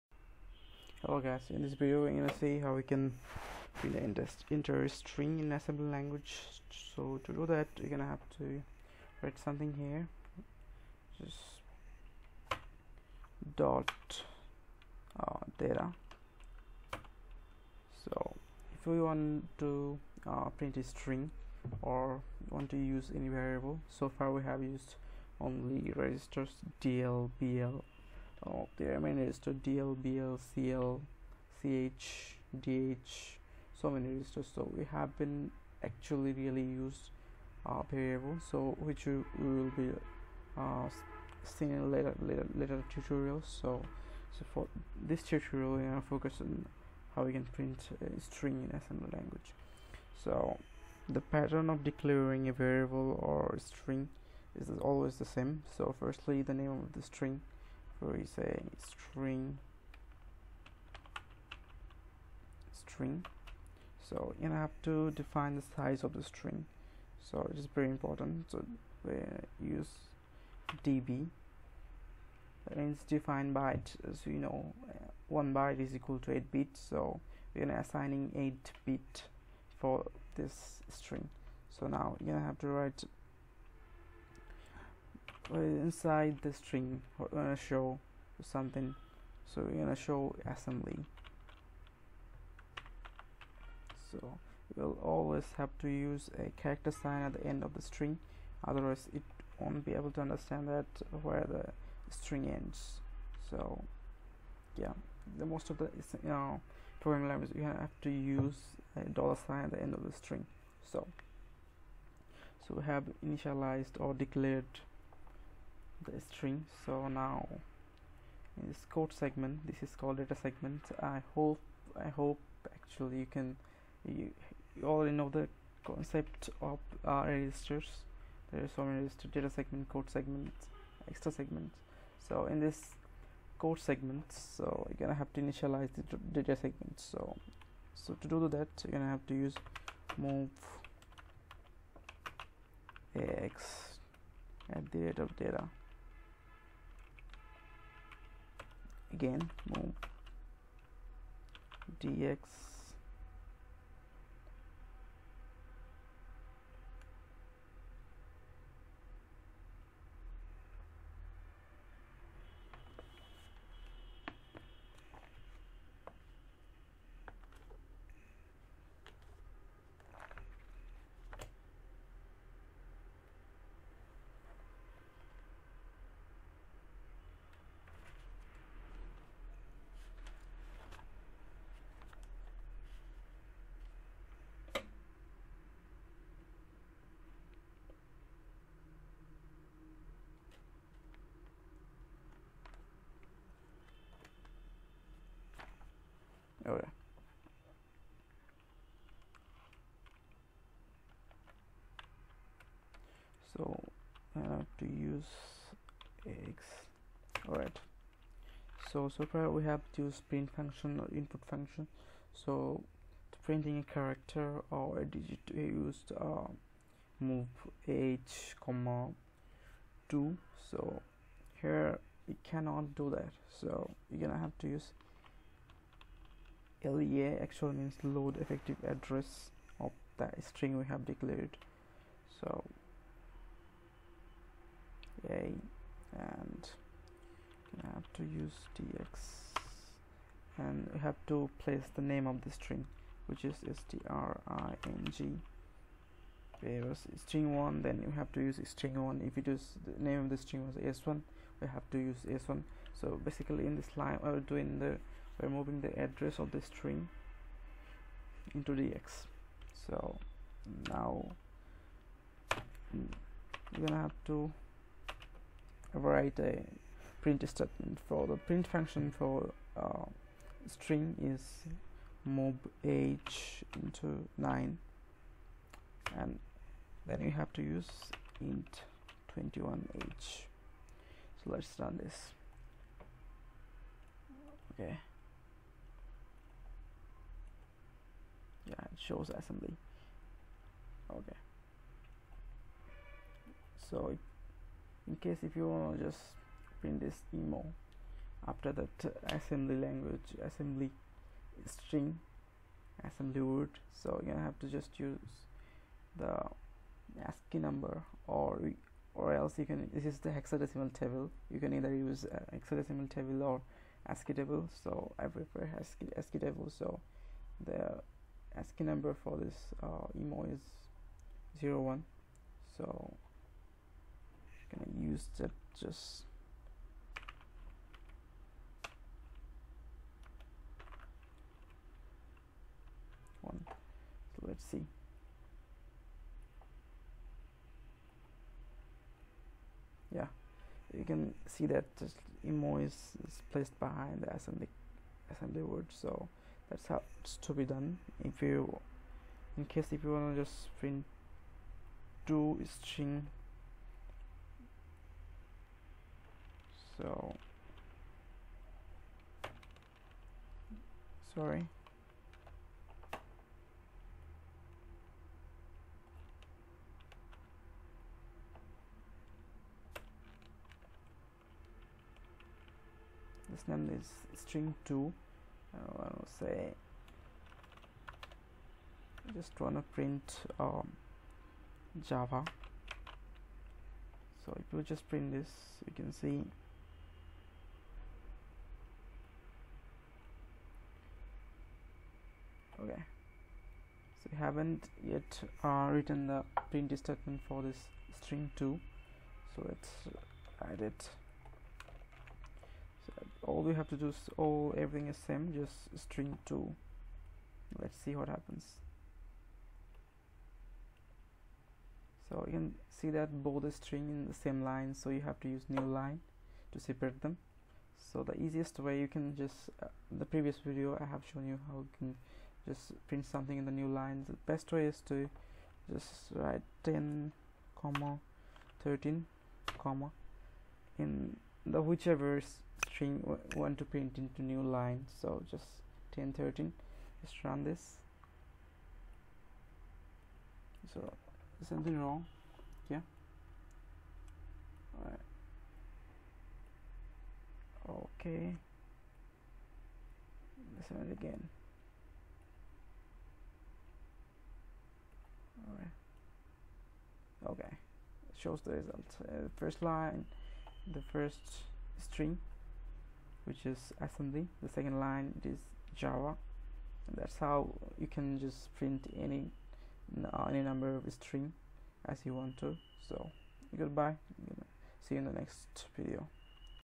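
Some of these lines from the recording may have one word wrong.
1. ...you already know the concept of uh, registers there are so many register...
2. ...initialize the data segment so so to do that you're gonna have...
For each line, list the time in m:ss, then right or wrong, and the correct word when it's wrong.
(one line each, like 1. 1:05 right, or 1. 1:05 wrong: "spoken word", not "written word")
1. 2:04 right
2. 2:15 right.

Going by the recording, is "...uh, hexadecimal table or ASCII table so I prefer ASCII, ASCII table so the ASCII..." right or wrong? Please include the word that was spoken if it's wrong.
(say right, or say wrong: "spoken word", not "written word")
right.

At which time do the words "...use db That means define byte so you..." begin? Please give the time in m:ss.
1:09.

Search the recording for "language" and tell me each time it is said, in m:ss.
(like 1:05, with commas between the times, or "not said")
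0:05, 0:49, 1:47, 4:59.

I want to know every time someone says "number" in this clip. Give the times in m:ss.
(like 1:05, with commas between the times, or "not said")
5:07, 5:18, 7:50.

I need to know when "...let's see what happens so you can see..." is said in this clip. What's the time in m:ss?
6:47.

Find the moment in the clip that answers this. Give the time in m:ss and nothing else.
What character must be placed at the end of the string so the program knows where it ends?
1:49.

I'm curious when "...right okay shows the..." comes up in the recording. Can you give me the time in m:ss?
7:35.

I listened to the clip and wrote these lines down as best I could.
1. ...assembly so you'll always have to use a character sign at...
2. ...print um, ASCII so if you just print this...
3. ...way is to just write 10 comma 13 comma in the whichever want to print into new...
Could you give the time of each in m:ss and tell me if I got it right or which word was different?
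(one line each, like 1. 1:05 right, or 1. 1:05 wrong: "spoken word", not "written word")
1. 1:30 right
2. 6:19 wrong: "Java", not "ASCII"
3. 7:04 right.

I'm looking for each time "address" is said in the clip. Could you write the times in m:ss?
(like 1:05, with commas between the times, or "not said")
3:48, 4:15.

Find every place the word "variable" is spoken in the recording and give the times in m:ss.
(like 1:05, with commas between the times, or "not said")
0:23, 0:37, 0:52.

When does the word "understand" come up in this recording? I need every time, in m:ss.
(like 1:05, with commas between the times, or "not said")
1:40.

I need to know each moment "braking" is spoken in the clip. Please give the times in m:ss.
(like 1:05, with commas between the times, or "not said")
not said.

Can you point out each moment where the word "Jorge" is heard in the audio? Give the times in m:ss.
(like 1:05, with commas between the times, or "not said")
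not said.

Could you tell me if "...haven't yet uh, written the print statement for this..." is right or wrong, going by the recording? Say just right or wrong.
right.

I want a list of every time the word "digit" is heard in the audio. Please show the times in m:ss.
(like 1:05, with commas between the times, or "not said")
3:35.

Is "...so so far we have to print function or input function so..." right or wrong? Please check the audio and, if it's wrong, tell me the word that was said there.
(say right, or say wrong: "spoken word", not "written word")
right.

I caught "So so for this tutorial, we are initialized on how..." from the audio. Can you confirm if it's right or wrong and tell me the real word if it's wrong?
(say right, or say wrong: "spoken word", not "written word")
wrong: "focused", not "initialized".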